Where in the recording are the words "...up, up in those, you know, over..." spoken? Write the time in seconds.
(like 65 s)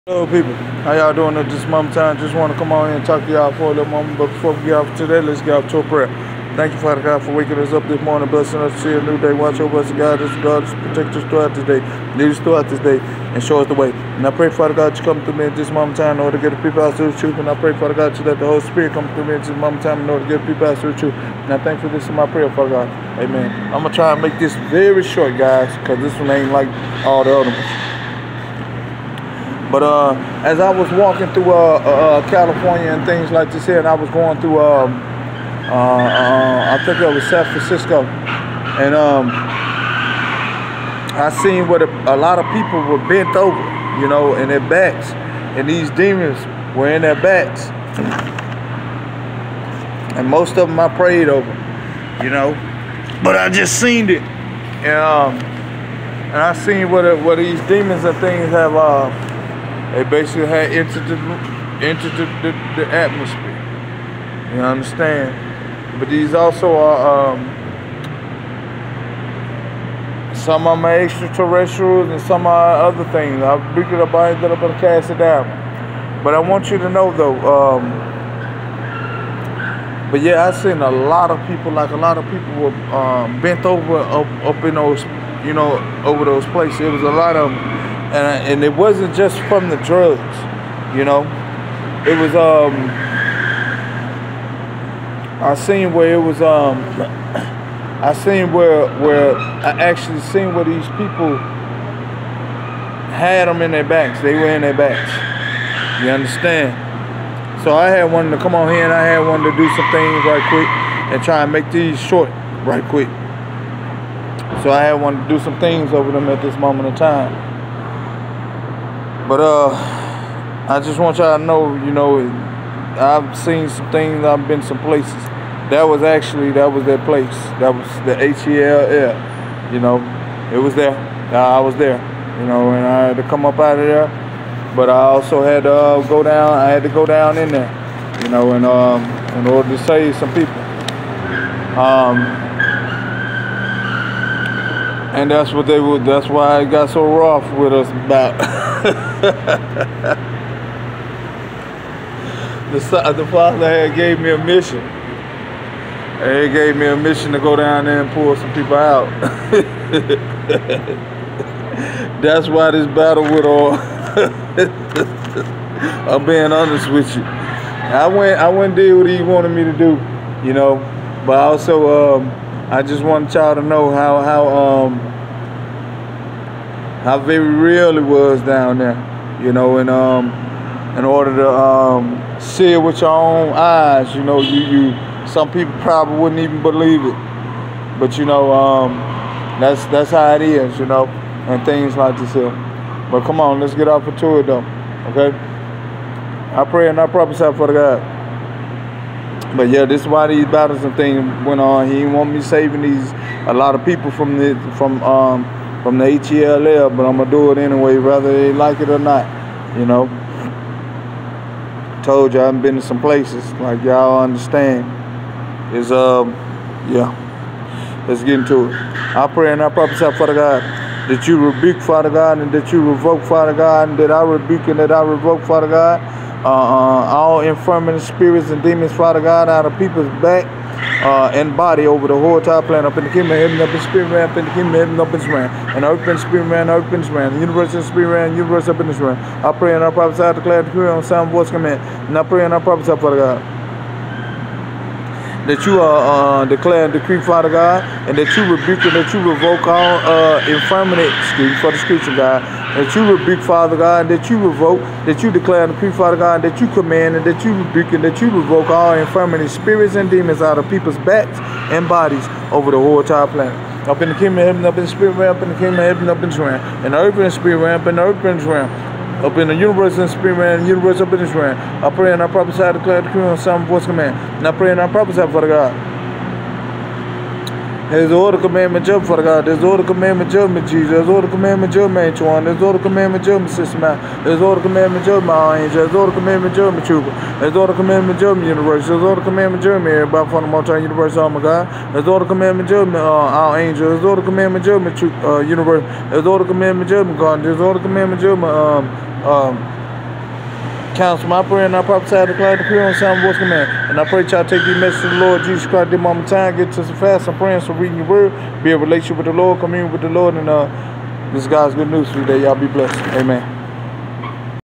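83 s.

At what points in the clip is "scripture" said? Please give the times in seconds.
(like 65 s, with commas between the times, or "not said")
251 s.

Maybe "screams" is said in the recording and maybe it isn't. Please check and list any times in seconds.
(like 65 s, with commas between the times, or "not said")
not said.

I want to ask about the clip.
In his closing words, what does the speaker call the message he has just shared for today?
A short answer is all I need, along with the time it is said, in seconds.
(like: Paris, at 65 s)
God's good news, at 311 s.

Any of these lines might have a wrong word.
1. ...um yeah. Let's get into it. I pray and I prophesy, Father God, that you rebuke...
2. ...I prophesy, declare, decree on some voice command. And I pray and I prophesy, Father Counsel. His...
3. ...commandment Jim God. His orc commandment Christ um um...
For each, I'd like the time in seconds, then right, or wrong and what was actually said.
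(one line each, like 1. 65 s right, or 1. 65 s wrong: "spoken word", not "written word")
1. 215 s right
2. 272 s wrong: "God", not "Counsel"
3. 296 s wrong: "Jim", not "Christ".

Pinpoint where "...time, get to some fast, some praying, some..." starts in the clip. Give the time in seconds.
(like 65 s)
306 s.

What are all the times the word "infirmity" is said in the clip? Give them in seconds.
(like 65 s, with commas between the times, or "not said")
227 s, 250 s, 258 s.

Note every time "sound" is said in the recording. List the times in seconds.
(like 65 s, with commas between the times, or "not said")
241 s, 302 s.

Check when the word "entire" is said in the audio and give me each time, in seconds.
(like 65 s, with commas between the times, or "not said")
232 s, 263 s.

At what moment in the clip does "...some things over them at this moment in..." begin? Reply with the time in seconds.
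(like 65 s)
115 s.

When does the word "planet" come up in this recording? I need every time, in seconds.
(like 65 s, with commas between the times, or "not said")
232 s, 263 s.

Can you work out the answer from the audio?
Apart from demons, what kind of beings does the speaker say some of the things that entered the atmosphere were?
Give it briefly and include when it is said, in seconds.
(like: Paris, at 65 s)
extraterrestrials, at 70 s.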